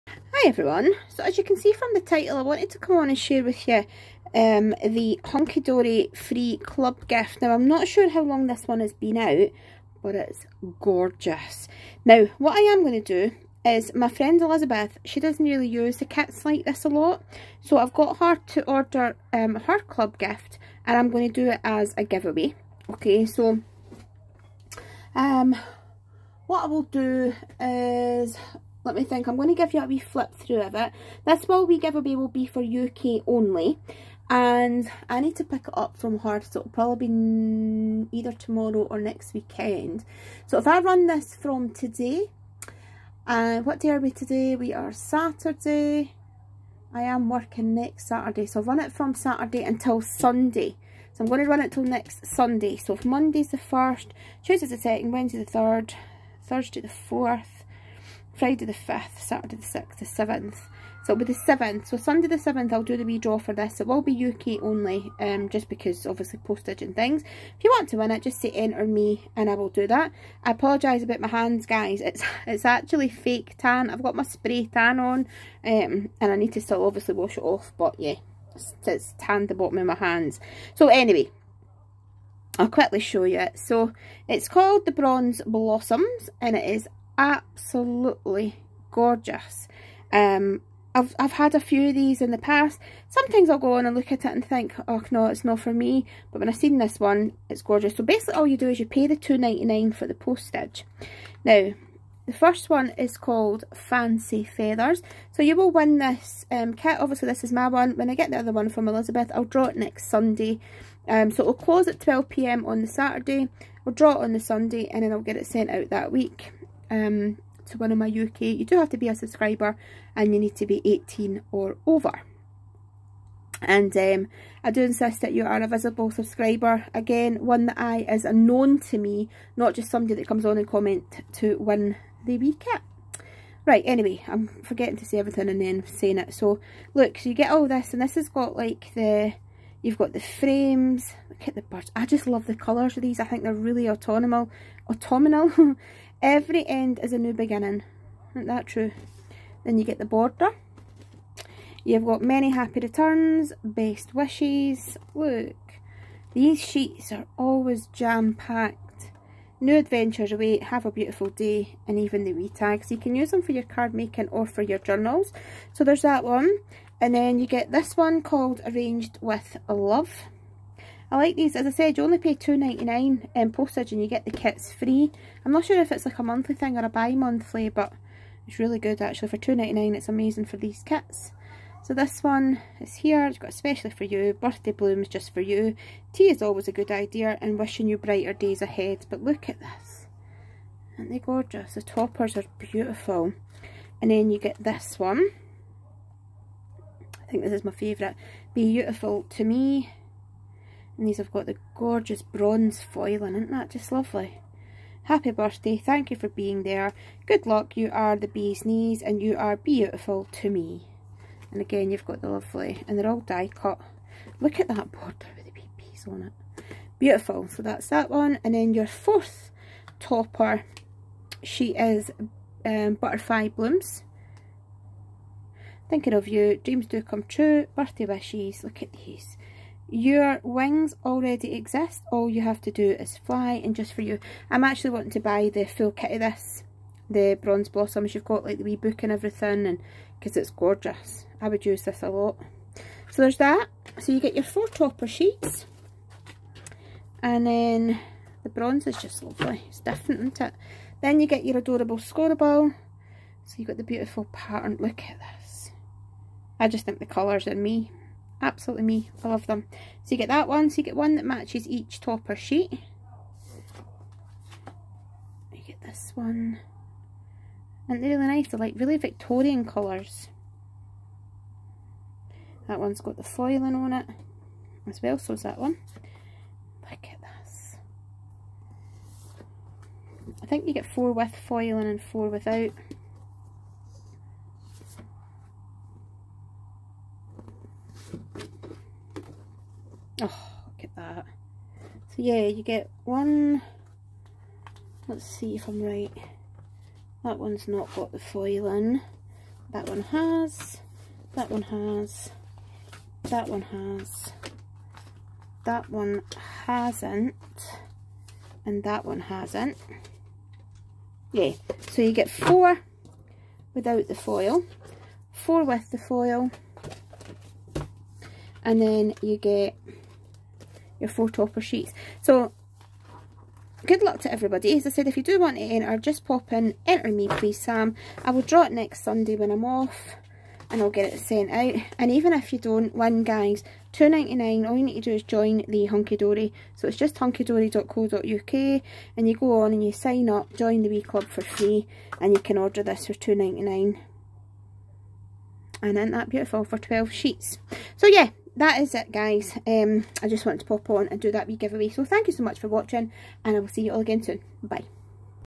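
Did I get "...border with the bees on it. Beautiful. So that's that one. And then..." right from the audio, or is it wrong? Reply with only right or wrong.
right.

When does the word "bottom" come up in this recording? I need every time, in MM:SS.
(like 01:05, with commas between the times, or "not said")
01:19.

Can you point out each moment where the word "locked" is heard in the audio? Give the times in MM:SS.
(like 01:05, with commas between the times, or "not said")
not said.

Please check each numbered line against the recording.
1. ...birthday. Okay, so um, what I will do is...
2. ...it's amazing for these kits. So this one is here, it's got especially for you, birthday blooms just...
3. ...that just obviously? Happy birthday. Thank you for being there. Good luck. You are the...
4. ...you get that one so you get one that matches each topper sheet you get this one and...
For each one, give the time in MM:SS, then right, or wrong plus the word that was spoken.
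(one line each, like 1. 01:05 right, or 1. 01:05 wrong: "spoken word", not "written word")
1. 00:22 wrong: "giveaway", not "birthday"
2. 02:59 right
3. 03:23 wrong: "lovely", not "obviously"
4. 04:20 right.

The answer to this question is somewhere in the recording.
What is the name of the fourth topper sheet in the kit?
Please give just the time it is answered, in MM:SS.
03:42.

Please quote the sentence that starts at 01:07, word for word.
If you want to win it, just say enter me and I will do that.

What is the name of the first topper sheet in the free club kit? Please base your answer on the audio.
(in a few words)
Fancy Feathers.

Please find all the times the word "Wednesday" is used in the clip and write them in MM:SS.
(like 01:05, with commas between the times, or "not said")
00:55.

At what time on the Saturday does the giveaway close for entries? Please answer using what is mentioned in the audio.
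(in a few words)
12pm.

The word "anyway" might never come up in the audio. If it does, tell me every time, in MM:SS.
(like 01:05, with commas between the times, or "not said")
01:20, 02:13.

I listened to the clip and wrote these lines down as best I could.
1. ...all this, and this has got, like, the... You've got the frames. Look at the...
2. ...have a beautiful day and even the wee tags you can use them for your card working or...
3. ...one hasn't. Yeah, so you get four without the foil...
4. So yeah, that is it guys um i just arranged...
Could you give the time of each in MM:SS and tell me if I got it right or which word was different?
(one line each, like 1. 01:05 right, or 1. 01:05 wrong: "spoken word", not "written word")
1. 02:17 right
2. 02:40 wrong: "making", not "working"
3. 05:09 right
4. 05:47 wrong: "wanted", not "arranged".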